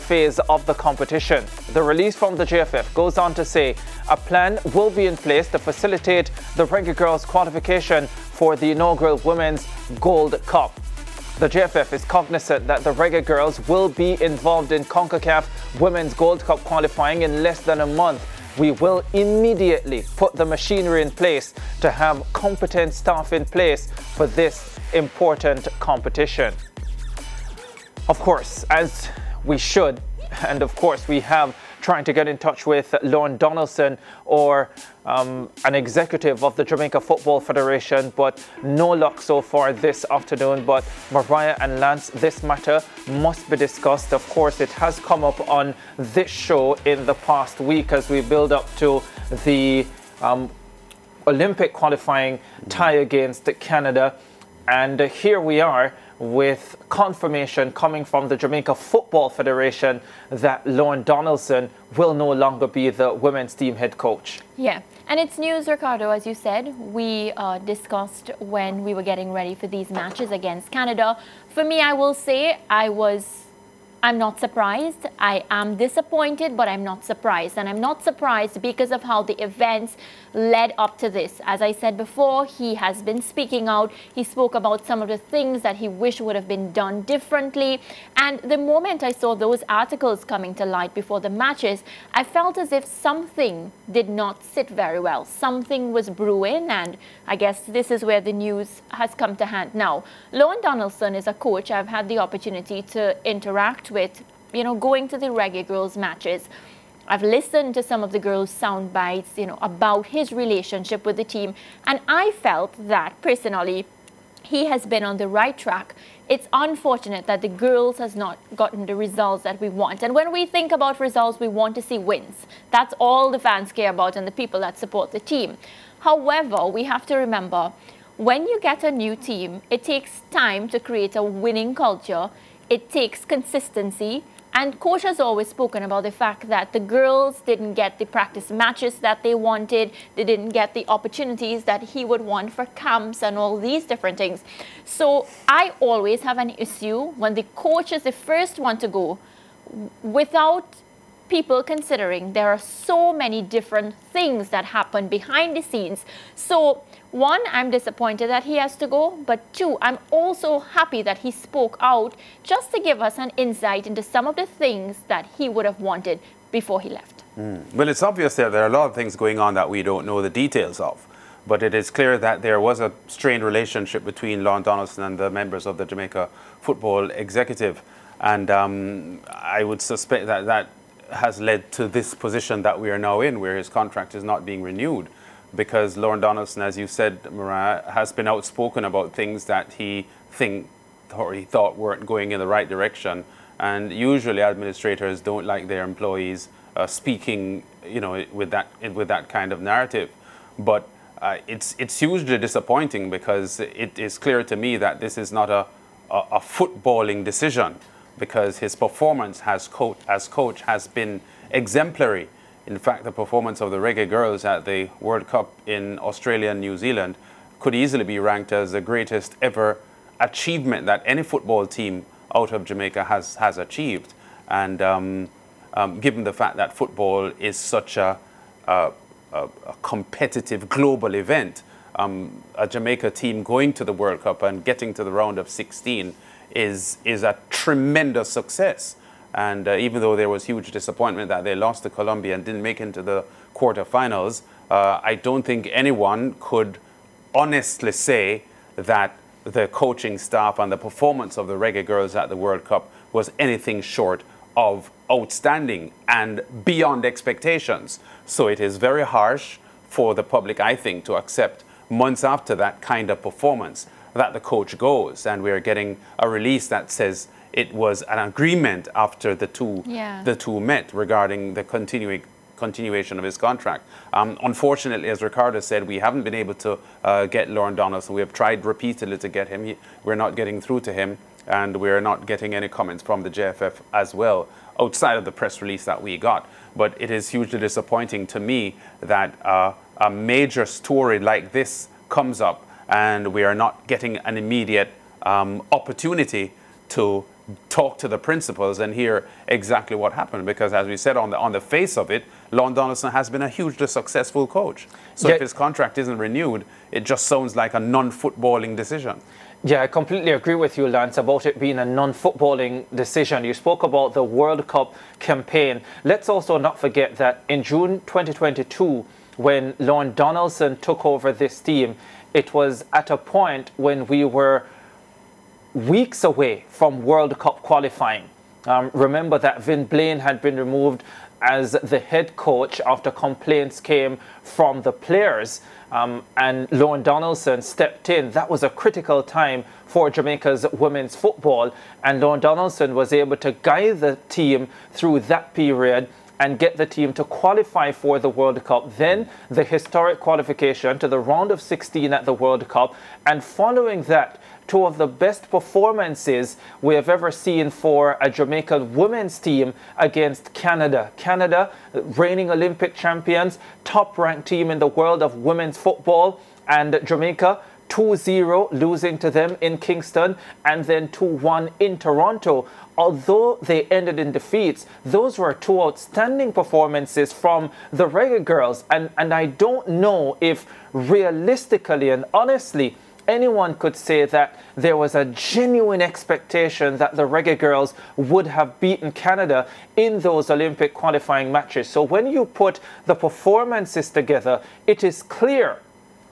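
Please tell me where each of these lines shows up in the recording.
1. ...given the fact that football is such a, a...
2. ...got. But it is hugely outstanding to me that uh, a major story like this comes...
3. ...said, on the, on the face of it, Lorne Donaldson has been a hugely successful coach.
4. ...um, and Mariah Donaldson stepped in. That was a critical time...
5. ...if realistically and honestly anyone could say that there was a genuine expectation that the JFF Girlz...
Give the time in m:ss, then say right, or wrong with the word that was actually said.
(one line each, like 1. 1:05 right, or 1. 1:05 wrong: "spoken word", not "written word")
1. 3:46 right
2. 4:46 wrong: "disappointing", not "outstanding"
3. 5:00 right
4. 5:35 wrong: "Lorne", not "Mariah"
5. 6:20 wrong: "Reggae", not "JFF".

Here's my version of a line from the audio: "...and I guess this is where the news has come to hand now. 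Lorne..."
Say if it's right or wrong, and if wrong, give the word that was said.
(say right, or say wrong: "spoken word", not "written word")
right.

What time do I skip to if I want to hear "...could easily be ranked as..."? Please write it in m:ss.
3:37.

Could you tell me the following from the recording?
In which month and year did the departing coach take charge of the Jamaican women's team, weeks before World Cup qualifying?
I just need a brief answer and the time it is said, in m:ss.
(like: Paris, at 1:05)
June 2022, at 5:17.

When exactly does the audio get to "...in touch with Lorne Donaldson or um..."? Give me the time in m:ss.
0:32.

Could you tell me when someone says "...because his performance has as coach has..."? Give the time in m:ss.
3:28.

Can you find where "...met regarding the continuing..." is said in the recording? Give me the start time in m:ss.
4:30.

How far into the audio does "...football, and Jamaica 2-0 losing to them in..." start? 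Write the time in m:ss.
6:05.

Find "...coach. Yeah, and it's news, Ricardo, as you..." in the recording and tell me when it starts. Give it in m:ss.
1:03.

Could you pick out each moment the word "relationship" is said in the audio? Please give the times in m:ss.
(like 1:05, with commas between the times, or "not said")
1:50, 2:53.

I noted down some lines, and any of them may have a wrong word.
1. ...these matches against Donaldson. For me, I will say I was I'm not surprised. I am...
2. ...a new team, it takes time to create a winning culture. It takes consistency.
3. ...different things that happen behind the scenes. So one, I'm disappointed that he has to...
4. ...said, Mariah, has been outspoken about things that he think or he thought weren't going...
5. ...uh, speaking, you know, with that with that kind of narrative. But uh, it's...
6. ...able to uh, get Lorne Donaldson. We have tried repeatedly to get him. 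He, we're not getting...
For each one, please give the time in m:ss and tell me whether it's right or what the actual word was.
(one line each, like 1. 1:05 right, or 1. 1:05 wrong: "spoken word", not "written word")
1. 1:09 wrong: "Canada", not "Donaldson"
2. 2:08 right
3. 2:33 right
4. 3:06 right
5. 3:16 right
6. 4:36 right.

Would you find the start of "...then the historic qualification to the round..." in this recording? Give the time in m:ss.
5:48.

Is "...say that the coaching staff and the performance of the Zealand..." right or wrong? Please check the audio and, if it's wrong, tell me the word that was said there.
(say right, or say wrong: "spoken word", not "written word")
wrong: "Reggae", not "Zealand".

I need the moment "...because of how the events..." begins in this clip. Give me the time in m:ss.
1:18.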